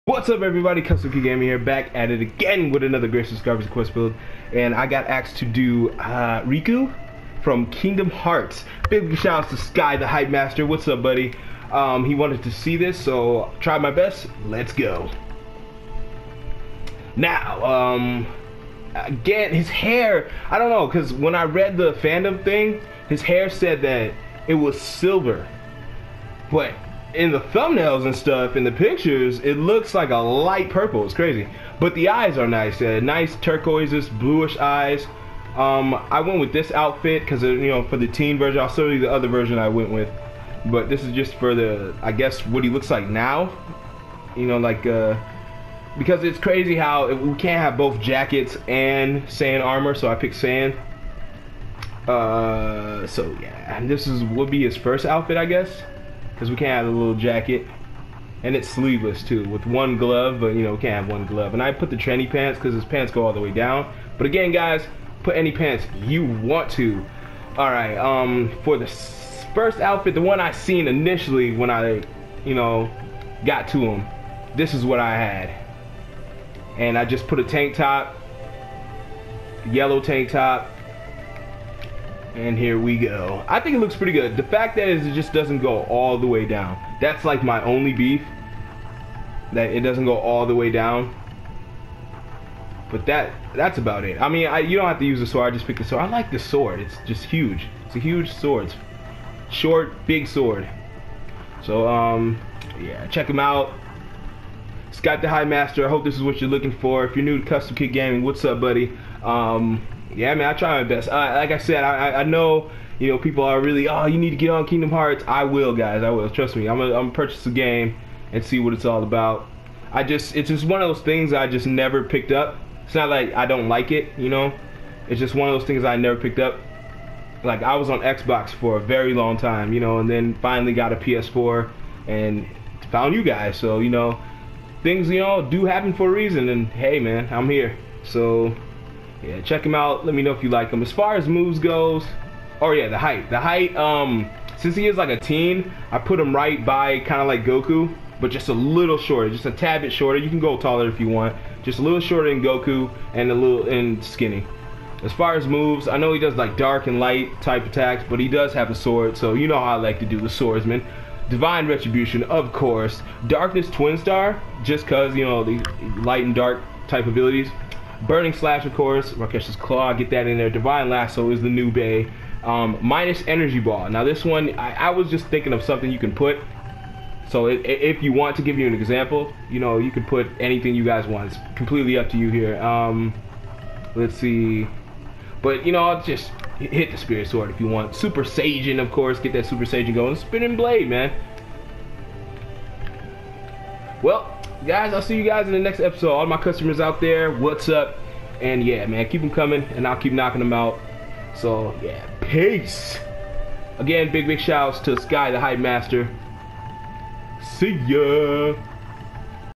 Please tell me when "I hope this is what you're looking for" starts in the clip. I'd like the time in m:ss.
1:45.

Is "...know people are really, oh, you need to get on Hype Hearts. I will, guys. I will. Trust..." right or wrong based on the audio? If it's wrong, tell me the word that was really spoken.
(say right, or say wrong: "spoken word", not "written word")
wrong: "Kingdom", not "Hype".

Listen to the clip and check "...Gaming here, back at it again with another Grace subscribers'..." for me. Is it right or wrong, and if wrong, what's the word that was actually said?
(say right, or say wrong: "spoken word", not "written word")
right.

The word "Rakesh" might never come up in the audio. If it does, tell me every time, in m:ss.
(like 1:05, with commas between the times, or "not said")
2:49.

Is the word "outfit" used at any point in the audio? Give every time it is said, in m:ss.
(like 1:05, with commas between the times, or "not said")
0:36, 0:55, 1:09.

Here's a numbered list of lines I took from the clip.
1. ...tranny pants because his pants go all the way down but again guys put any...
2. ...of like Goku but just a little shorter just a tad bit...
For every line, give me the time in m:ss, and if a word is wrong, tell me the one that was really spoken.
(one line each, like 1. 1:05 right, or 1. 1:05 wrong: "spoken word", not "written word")
1. 1:01 right
2. 2:27 right.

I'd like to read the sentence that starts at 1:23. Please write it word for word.
I think it looks pretty good.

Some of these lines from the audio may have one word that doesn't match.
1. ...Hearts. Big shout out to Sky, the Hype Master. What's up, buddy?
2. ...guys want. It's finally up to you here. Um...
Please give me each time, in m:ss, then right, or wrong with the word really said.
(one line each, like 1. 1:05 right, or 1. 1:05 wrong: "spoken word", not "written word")
1. 0:08 right
2. 3:00 wrong: "completely", not "finally".